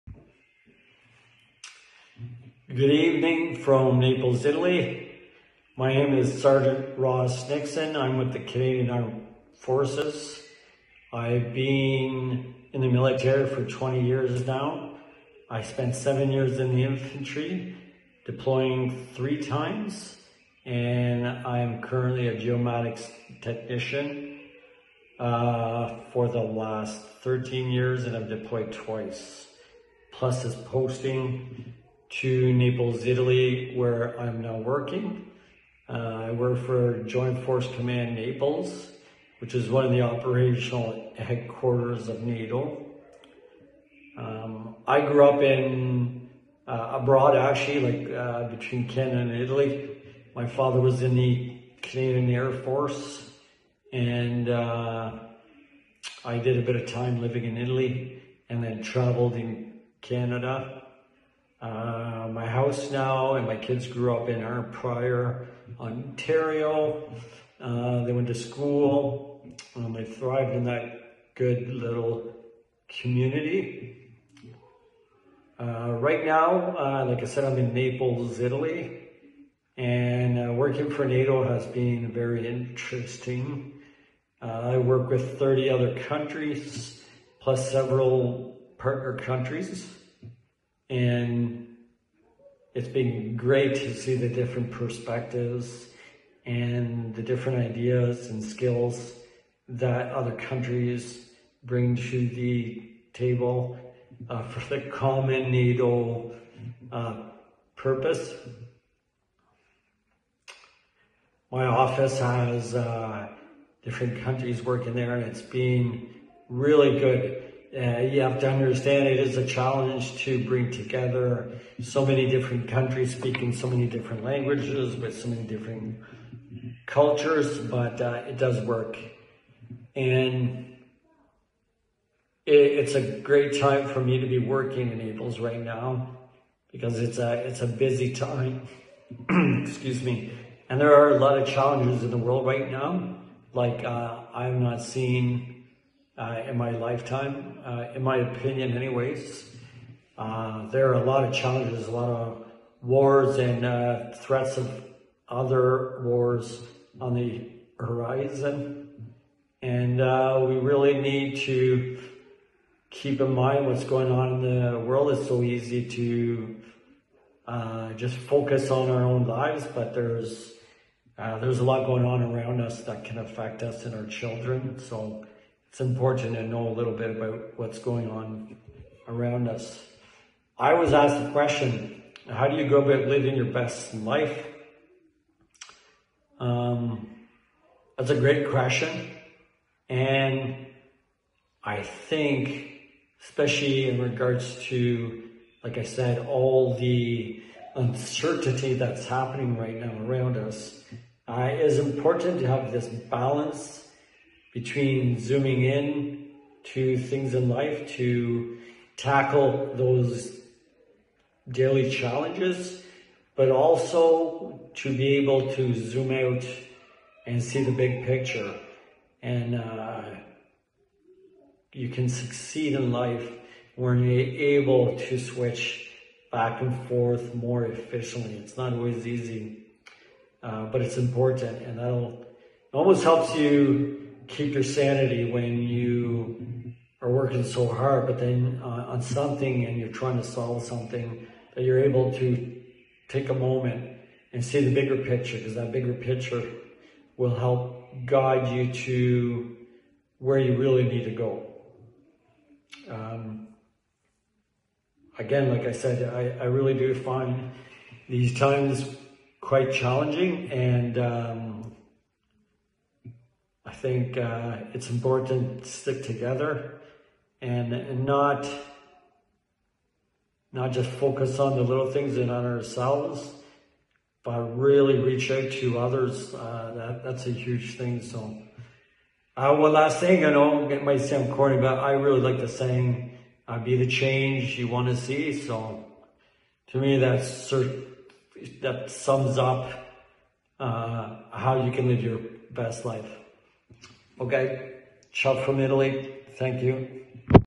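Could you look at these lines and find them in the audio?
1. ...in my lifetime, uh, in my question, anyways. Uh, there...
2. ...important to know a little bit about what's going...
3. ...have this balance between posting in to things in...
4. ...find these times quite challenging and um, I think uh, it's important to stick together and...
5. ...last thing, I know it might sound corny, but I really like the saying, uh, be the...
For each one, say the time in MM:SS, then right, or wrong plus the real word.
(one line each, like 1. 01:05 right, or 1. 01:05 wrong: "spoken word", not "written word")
1. 02:26 wrong: "opinion", not "question"
2. 02:55 right
3. 03:22 wrong: "zooming", not "posting"
4. 04:16 right
5. 04:39 right.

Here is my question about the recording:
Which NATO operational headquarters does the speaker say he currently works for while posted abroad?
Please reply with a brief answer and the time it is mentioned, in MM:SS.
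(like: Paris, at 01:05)
Joint Force Command Naples, at 00:37.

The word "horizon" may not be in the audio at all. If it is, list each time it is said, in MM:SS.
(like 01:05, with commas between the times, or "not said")
02:37.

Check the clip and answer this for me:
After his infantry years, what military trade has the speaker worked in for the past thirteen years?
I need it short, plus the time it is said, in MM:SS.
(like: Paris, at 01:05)
Geomatics technician, at 00:22.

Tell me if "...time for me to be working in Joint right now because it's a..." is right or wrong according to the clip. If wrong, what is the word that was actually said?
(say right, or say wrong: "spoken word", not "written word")
wrong: "Naples", not "Joint".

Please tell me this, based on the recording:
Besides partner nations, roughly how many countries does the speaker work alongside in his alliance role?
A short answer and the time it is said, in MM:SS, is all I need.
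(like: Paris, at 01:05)
30, at 01:25.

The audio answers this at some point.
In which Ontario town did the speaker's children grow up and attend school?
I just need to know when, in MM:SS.
01:04.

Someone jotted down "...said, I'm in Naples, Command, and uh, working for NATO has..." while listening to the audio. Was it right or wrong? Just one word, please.
wrong.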